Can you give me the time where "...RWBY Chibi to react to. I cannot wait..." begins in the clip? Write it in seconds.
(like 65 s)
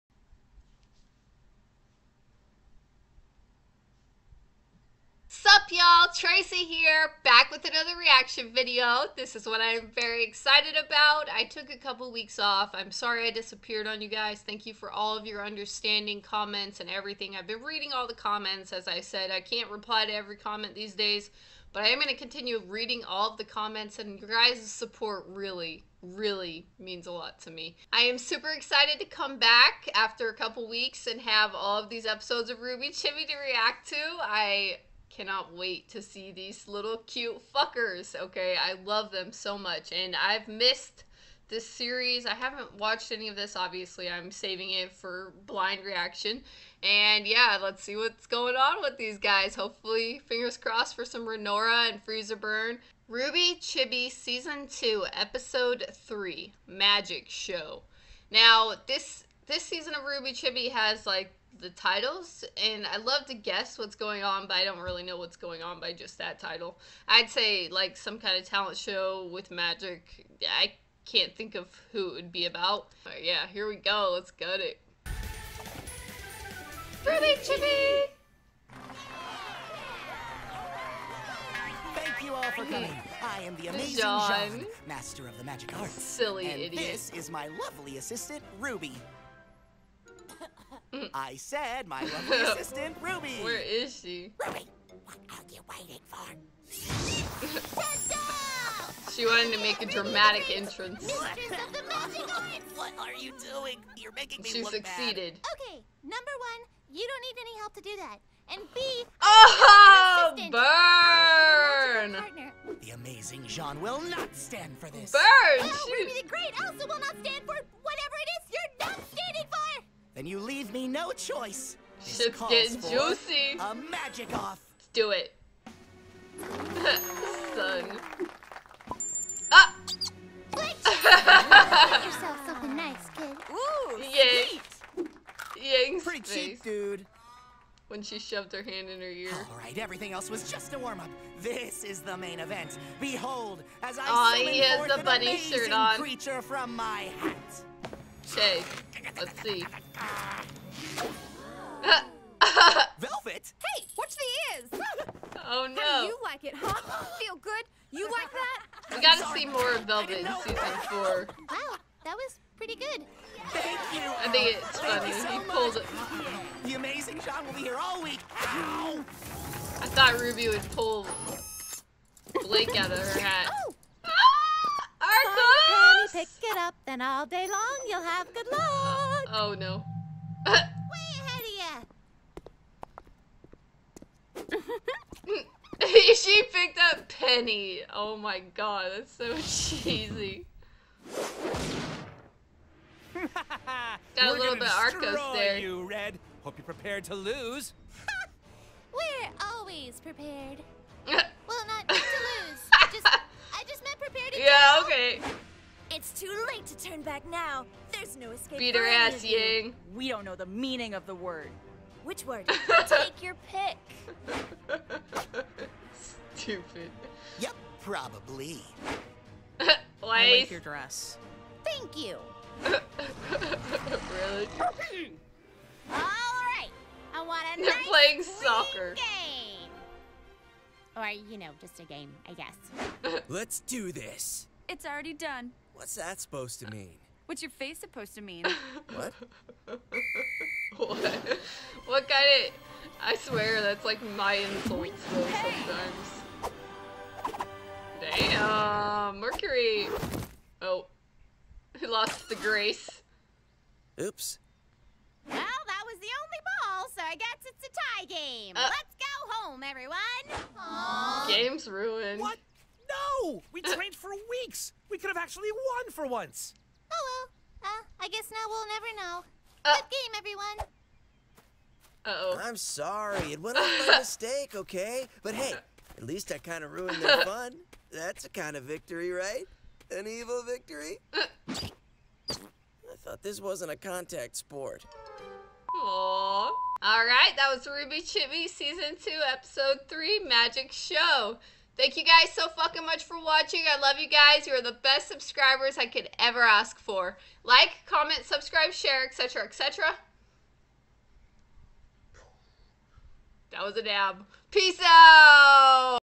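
32 s.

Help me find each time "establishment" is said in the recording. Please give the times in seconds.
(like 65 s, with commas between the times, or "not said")
not said.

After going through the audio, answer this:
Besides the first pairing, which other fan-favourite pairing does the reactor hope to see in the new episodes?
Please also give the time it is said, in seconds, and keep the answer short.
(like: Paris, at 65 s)
Freezer Burn, at 52 s.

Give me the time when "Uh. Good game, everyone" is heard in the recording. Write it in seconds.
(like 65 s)
269 s.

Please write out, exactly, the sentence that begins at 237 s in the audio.
What's your face supposed to mean?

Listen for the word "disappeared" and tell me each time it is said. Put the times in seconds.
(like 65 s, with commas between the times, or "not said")
13 s.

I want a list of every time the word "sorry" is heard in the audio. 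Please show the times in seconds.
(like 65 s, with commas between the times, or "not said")
12 s, 272 s.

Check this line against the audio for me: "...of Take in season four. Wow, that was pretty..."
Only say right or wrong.
wrong.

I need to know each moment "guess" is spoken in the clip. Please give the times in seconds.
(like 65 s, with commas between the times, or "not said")
63 s, 232 s, 257 s, 268 s.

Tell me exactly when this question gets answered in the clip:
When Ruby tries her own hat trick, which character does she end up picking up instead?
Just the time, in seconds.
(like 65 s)
187 s.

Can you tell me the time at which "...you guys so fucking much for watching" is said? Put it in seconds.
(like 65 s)
291 s.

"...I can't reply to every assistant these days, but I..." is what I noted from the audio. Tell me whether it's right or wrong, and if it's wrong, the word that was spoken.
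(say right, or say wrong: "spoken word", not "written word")
wrong: "comment", not "assistant".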